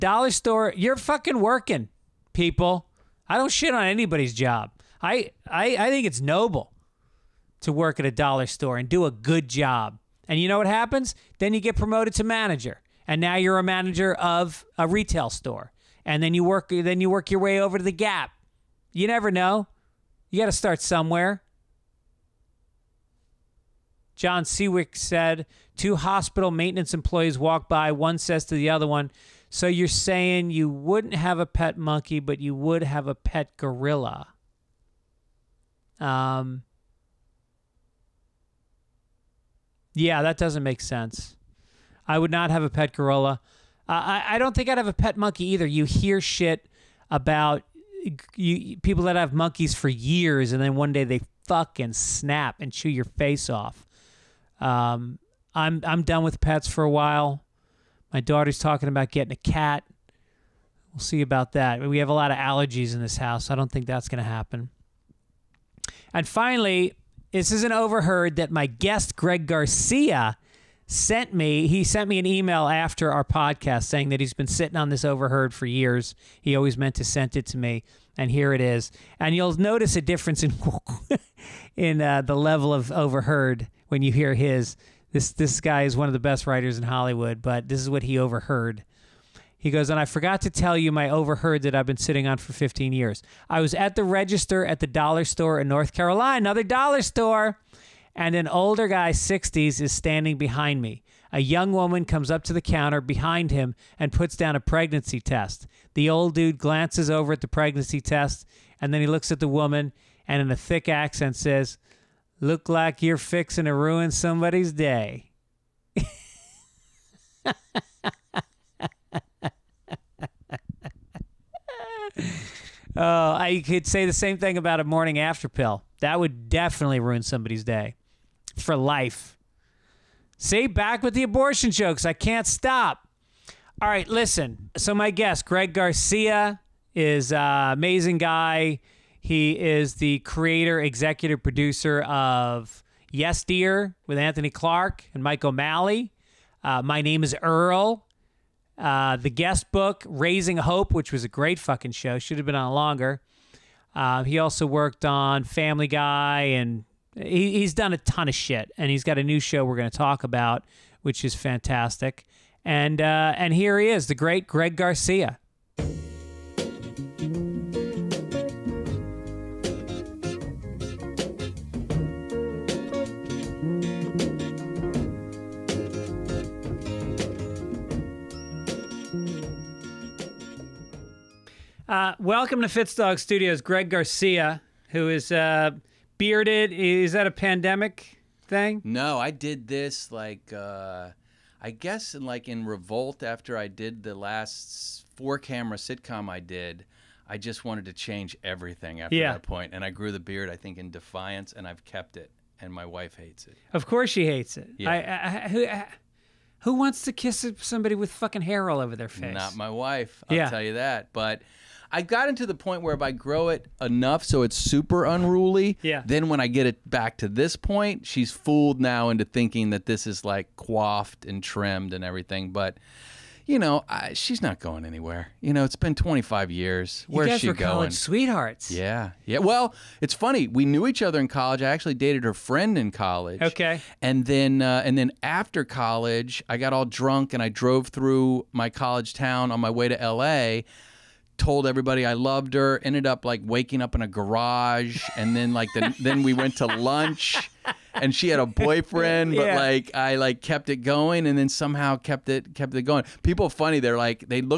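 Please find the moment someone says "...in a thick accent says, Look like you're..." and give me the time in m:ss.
1:50.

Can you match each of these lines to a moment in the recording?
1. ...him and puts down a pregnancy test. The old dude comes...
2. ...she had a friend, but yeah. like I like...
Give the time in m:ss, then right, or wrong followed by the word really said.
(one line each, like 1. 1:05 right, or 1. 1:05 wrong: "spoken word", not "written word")
1. 1:43 wrong: "glances", not "comes"
2. 4:08 wrong: "boyfriend", not "friend".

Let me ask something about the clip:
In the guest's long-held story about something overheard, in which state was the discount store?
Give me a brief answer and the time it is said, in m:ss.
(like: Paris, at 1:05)
North Carolina, at 1:35.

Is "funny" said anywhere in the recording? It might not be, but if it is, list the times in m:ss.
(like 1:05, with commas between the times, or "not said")
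3:50, 4:13.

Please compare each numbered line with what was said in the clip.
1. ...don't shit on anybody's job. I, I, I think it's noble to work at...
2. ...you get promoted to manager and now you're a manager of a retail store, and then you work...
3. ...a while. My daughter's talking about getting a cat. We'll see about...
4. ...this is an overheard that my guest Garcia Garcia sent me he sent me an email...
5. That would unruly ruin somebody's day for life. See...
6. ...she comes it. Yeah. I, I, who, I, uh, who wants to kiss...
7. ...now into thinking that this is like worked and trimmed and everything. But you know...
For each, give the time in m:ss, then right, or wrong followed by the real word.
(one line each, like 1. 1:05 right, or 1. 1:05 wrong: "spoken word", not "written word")
1. 0:03 right
2. 0:11 right
3. 0:56 right
4. 1:07 wrong: "Greg", not "Garcia"
5. 2:05 wrong: "definitely", not "unruly"
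6. 3:24 wrong: "hates", not "comes"
7. 3:38 wrong: "coiffed", not "worked".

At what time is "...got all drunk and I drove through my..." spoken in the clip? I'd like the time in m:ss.
3:56.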